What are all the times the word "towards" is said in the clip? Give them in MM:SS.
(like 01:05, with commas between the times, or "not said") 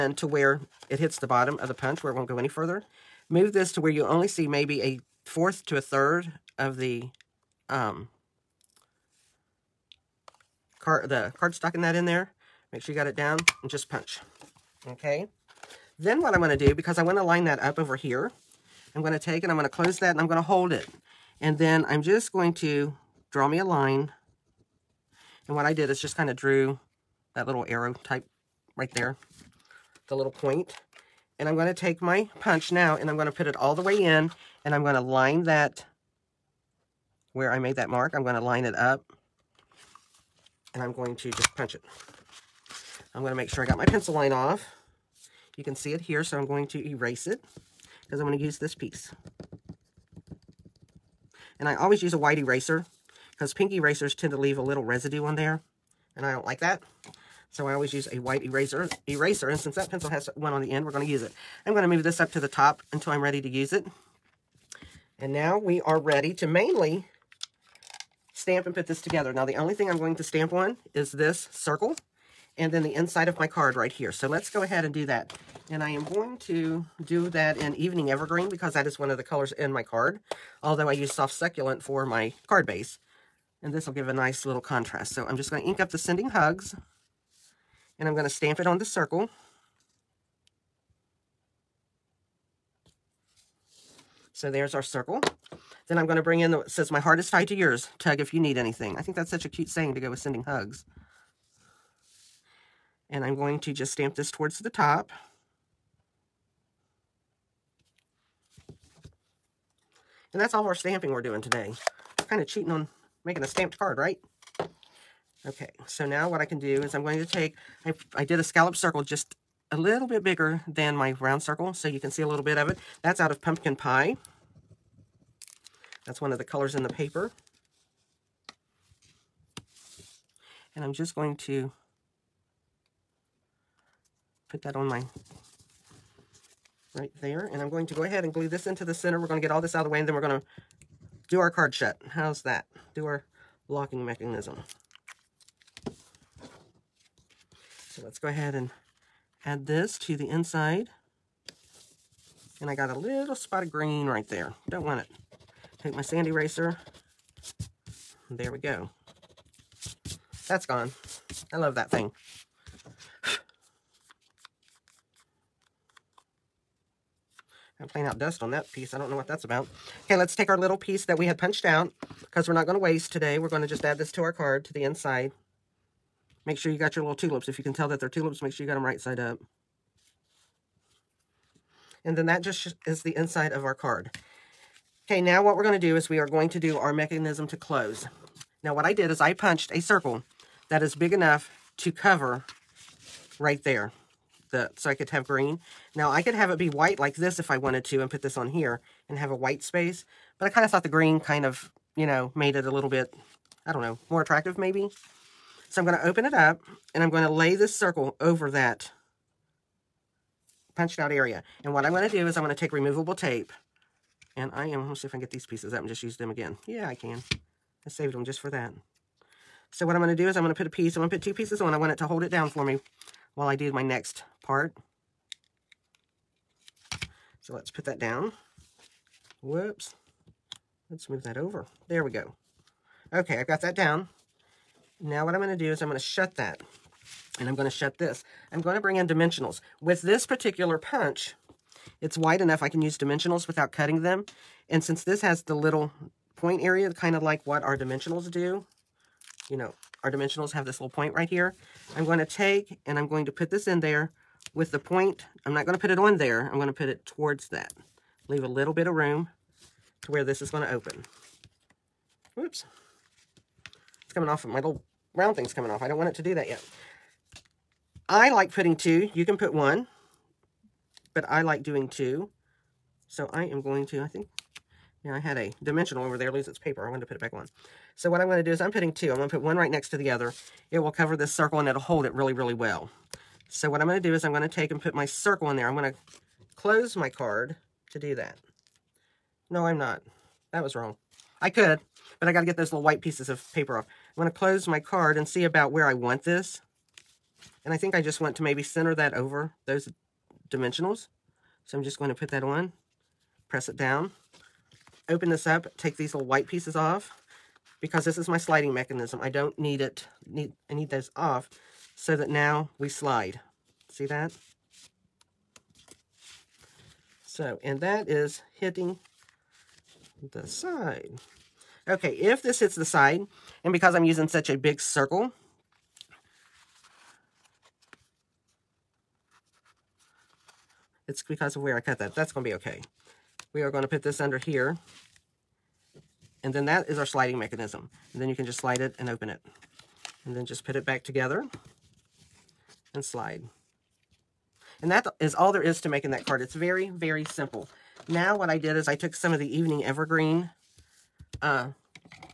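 01:44, 04:17.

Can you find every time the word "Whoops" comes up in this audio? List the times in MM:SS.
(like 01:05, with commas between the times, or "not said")
03:49, 04:22.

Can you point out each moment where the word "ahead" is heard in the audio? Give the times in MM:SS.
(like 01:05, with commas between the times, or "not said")
01:14, 02:18, 02:28.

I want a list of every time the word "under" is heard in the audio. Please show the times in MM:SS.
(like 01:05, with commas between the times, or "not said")
05:34.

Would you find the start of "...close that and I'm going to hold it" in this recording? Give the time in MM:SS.
00:19.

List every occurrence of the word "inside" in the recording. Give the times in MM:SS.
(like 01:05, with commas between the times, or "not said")
01:12, 02:30, 02:54, 03:03.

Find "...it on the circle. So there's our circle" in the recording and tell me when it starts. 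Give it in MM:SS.
01:28.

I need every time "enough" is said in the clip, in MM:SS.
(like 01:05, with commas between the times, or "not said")
03:11, 04:02.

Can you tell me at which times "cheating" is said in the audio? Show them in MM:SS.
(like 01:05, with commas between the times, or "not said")
01:52.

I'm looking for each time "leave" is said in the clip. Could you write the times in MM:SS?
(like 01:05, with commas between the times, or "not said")
00:54, 04:18.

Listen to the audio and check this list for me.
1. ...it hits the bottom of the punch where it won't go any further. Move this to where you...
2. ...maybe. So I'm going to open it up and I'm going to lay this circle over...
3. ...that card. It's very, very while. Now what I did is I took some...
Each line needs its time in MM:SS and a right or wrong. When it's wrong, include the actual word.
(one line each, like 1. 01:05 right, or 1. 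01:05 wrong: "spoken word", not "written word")
1. 00:00 right
2. 03:24 right
3. 05:46 wrong: "simple", not "while".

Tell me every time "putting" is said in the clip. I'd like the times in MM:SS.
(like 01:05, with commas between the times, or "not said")
04:28, 04:38.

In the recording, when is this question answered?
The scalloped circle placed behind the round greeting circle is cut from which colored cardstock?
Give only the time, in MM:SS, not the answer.
02:03.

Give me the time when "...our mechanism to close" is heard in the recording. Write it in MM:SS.
03:06.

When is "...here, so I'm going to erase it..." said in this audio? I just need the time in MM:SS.
00:46.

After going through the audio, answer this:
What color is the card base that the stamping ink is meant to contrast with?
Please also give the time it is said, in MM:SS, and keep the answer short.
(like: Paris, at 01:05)
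Soft Succulent, at 01:21.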